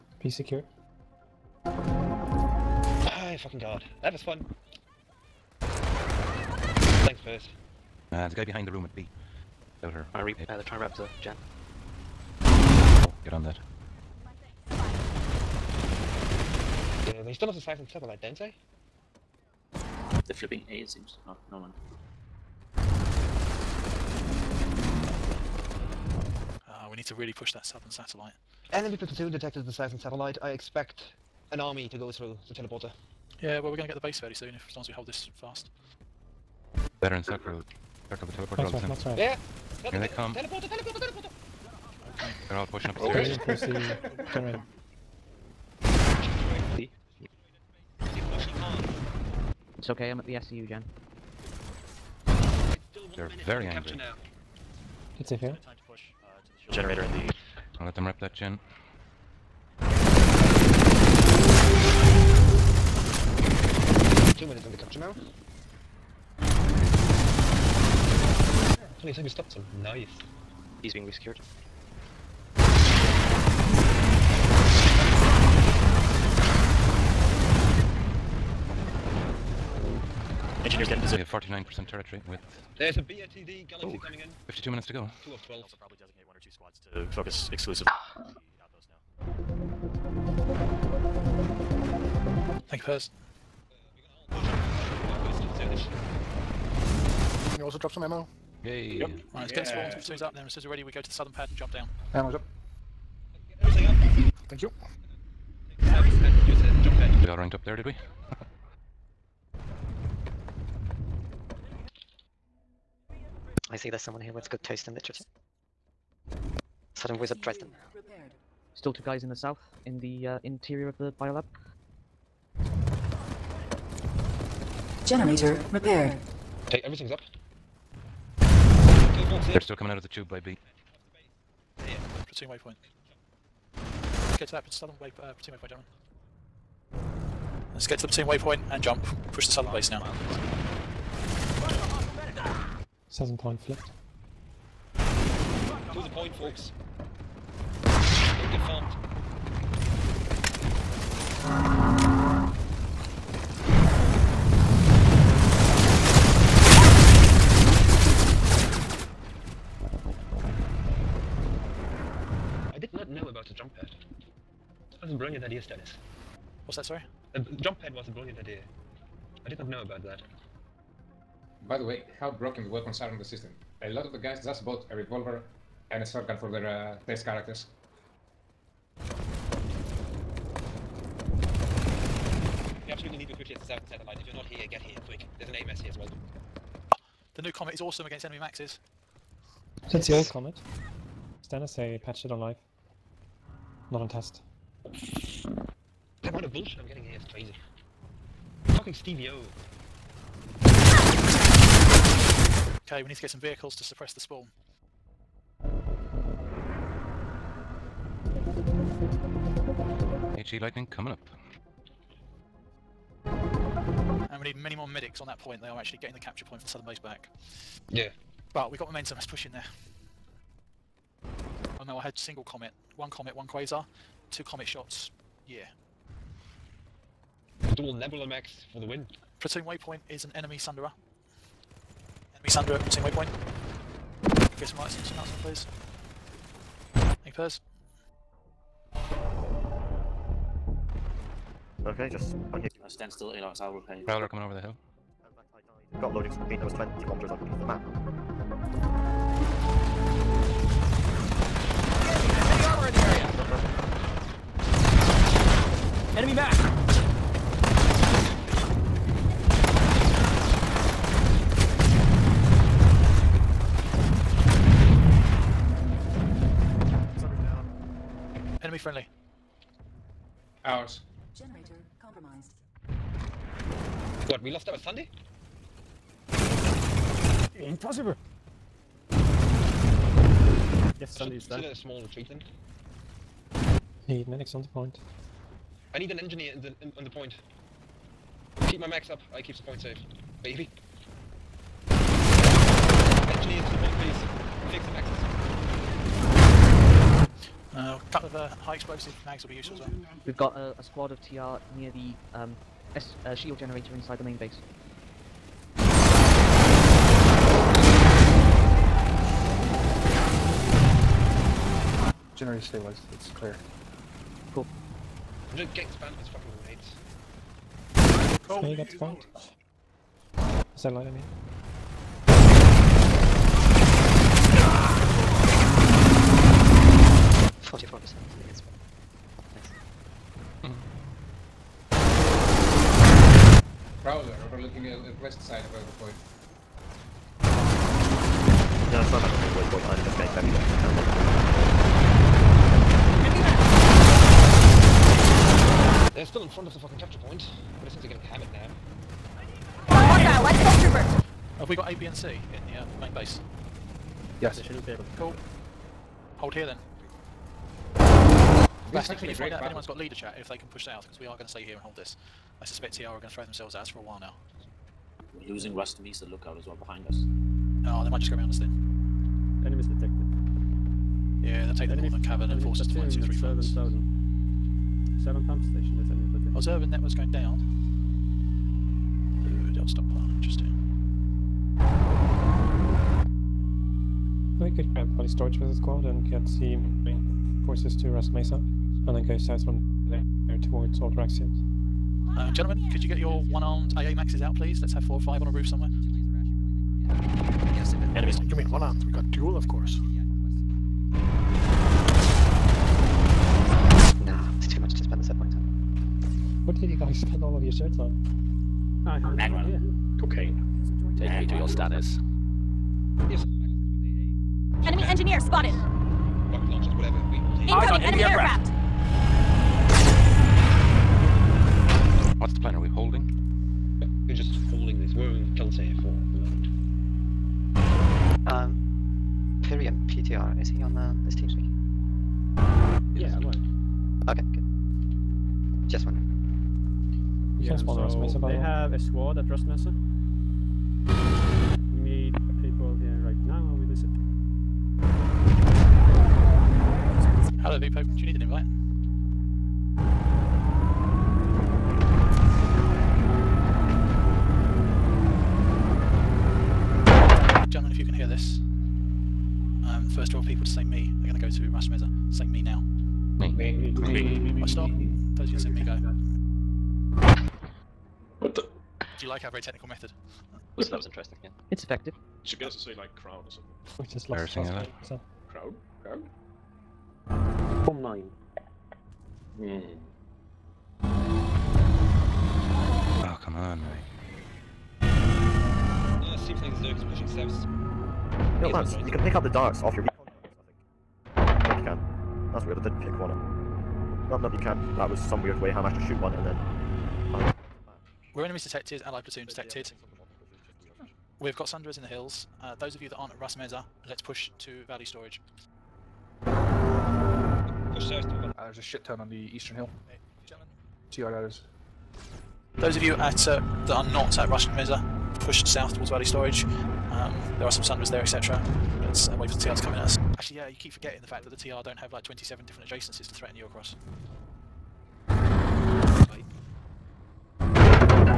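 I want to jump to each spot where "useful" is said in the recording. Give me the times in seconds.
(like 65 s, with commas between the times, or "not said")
299 s.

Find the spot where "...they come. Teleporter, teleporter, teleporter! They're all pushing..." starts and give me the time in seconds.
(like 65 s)
39 s.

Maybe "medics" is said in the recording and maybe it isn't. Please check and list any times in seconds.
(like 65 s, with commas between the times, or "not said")
214 s, 284 s.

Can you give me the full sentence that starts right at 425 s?
We're in Keltair for the moment.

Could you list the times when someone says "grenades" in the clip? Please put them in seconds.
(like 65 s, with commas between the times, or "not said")
318 s.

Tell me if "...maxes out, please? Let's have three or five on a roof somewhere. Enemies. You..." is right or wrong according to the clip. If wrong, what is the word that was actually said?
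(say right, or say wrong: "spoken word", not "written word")
wrong: "four", not "three".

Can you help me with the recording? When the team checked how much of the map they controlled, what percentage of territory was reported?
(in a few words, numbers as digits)
49%.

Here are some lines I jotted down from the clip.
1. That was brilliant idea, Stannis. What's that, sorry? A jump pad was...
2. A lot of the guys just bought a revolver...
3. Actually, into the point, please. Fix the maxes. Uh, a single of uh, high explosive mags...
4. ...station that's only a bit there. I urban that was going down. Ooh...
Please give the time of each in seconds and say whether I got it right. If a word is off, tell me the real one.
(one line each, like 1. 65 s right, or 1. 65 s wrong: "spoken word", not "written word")
1. 164 s right
2. 173 s right
3. 291 s wrong: "couple", not "single"
4. 375 s right.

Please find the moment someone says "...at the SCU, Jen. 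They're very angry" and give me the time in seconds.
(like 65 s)
50 s.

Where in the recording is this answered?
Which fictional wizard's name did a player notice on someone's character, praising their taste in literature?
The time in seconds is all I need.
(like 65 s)
117 s.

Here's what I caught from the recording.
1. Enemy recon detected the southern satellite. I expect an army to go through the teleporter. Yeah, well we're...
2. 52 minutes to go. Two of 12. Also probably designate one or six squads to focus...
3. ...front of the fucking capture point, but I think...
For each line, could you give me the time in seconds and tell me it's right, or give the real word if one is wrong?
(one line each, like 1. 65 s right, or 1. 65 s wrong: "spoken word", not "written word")
1. 28 s wrong: "platoon", not "recon"
2. 84 s wrong: "two", not "six"
3. 346 s right.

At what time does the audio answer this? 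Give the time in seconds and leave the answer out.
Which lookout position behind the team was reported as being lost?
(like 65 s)
365 s.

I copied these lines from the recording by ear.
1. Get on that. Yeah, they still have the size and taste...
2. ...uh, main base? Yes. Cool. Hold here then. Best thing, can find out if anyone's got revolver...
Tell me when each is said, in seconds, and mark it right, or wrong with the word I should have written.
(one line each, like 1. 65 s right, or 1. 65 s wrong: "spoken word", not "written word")
1. 13 s wrong: "satellite", not "taste"
2. 352 s wrong: "leader", not "revolver".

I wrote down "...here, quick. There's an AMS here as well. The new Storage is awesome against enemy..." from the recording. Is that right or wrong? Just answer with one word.
wrong.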